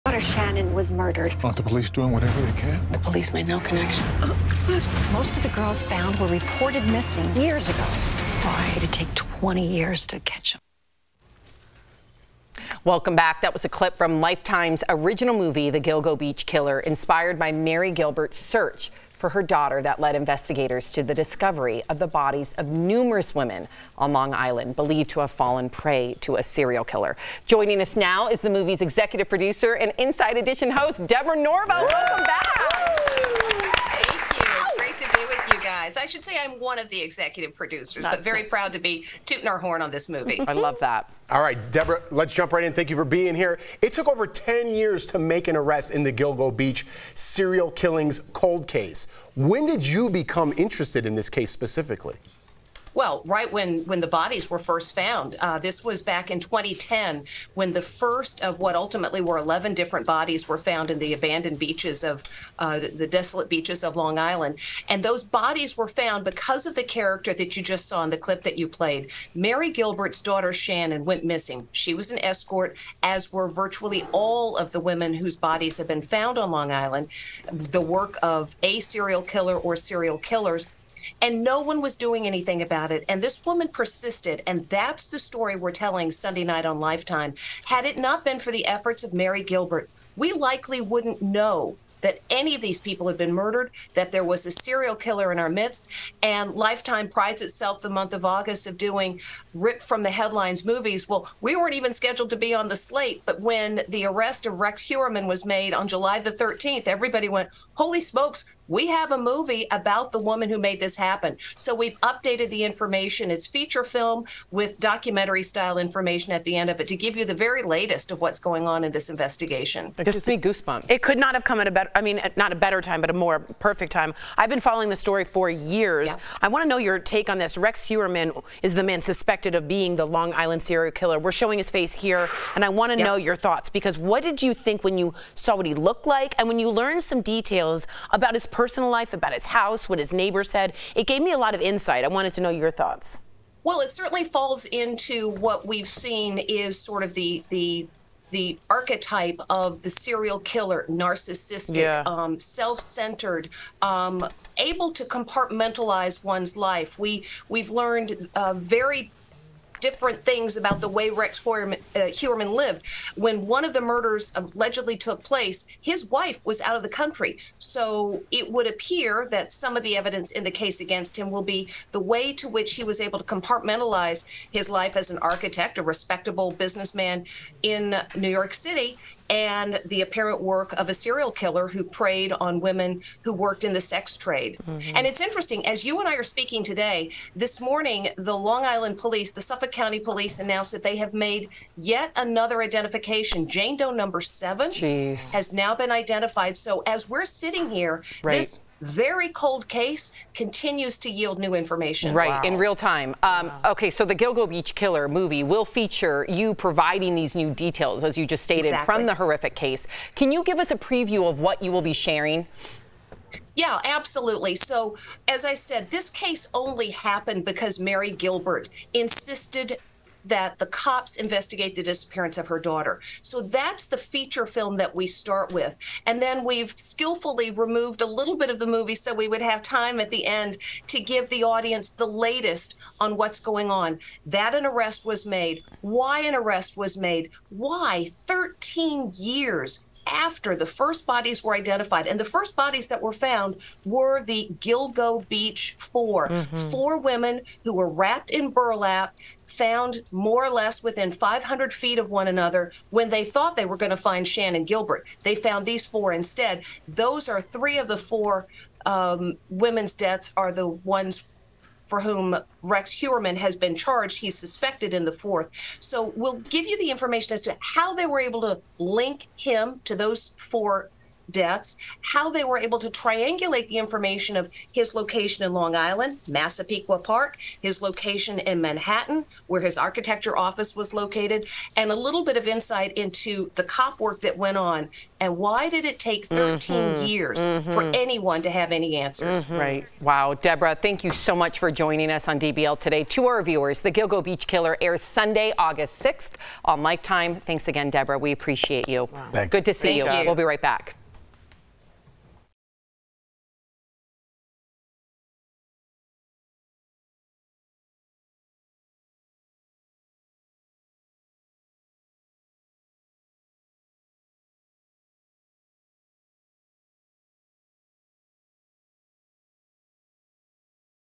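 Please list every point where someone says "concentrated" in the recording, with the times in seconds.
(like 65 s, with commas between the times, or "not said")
not said.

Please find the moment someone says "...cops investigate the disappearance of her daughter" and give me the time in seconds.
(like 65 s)
220 s.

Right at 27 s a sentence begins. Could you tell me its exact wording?
Joining us now is the movie's executive producer and Inside Edition host, Deborah Norville.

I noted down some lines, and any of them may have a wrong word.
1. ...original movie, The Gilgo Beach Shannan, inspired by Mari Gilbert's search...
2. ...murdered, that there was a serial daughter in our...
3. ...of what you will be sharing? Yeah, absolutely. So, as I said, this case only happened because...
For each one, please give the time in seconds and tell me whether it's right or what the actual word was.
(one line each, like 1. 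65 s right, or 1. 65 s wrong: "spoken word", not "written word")
1. 14 s wrong: "Killer", not "Shannan"
2. 93 s wrong: "killer", not "daughter"
3. 211 s right.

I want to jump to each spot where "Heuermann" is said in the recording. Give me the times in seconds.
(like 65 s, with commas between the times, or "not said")
104 s, 127 s, 161 s, 262 s.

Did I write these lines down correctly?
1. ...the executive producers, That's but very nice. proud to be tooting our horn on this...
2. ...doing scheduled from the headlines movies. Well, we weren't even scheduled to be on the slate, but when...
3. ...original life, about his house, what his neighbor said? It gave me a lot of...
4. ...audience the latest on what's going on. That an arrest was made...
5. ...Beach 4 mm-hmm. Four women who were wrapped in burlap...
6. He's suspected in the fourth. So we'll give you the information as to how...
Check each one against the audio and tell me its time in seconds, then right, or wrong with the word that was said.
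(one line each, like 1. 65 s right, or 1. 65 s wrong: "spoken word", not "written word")
1. 36 s right
2. 98 s wrong: "ripped", not "scheduled"
3. 138 s wrong: "personal", not "original"
4. 231 s right
5. 245 s right
6. 264 s right.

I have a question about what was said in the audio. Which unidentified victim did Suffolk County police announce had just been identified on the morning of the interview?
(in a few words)
Jane Doe number seven.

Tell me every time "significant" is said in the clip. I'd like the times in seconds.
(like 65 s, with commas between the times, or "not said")
not said.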